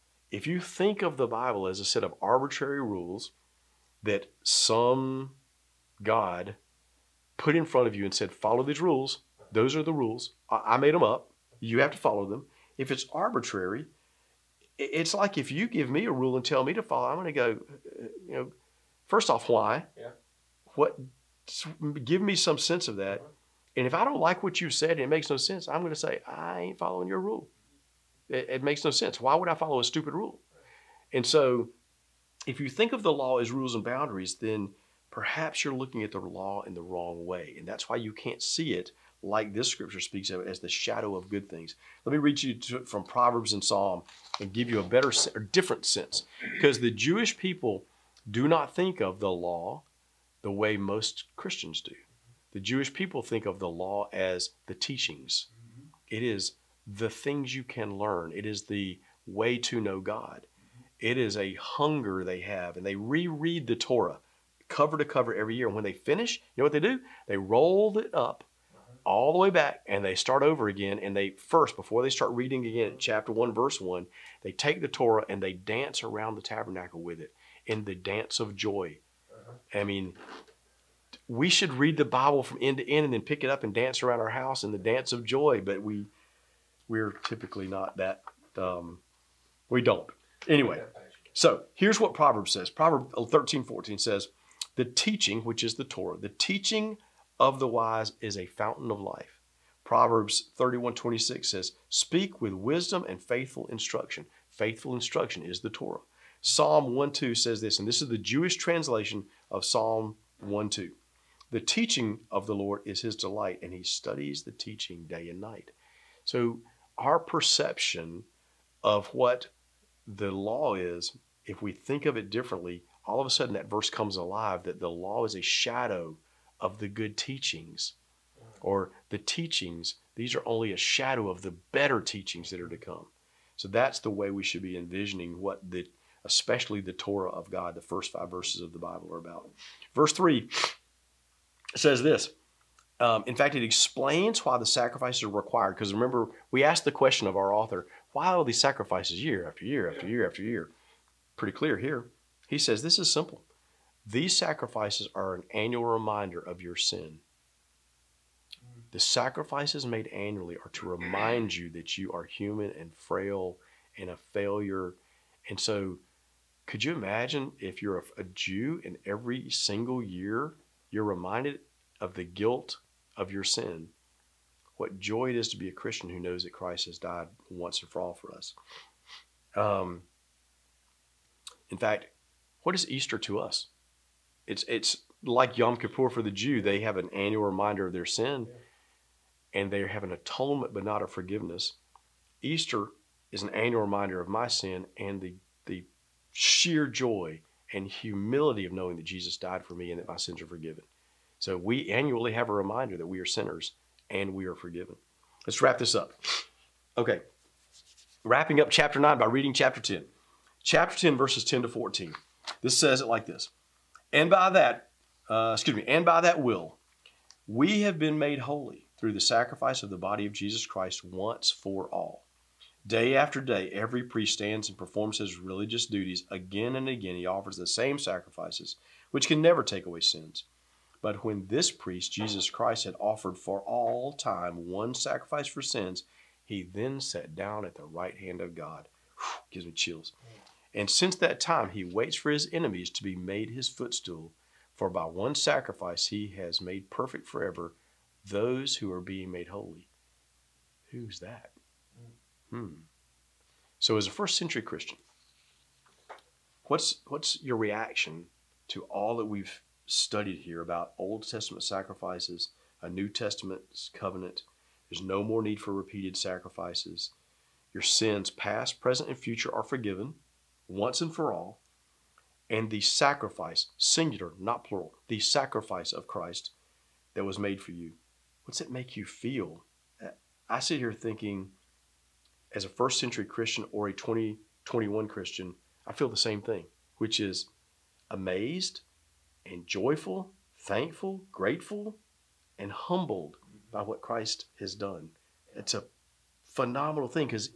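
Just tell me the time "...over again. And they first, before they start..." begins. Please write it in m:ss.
1:10.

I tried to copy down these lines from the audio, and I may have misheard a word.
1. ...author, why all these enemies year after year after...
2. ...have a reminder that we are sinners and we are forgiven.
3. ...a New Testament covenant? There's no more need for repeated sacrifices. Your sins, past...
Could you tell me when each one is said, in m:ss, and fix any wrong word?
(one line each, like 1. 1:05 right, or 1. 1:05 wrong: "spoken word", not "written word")
1. 2:27 wrong: "sacrifices", not "enemies"
2. 3:22 right
3. 4:22 right.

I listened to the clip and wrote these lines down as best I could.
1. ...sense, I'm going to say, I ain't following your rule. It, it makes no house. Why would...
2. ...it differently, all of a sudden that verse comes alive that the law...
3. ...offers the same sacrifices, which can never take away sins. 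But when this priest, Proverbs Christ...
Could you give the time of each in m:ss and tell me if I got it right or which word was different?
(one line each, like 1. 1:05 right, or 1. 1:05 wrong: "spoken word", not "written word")
1. 0:25 wrong: "sense", not "house"
2. 2:02 right
3. 3:47 wrong: "Jesus", not "Proverbs".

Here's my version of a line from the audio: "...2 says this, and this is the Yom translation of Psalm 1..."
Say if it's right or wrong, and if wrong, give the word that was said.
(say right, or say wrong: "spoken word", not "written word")
wrong: "Jewish", not "Yom".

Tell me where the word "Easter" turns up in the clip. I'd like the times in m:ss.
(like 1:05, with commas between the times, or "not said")
3:02, 3:12.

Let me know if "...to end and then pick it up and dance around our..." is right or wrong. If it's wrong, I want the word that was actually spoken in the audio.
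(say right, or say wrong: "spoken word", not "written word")
right.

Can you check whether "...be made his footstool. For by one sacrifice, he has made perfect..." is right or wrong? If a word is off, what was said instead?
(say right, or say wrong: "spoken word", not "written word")
right.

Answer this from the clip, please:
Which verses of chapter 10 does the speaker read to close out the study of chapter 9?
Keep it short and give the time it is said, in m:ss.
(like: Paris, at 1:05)
Verses 10 to 14, at 3:31.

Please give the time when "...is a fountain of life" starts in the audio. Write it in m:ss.
1:38.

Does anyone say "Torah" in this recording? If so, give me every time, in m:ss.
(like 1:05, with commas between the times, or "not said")
1:03, 1:14, 1:35, 1:45, 2:16.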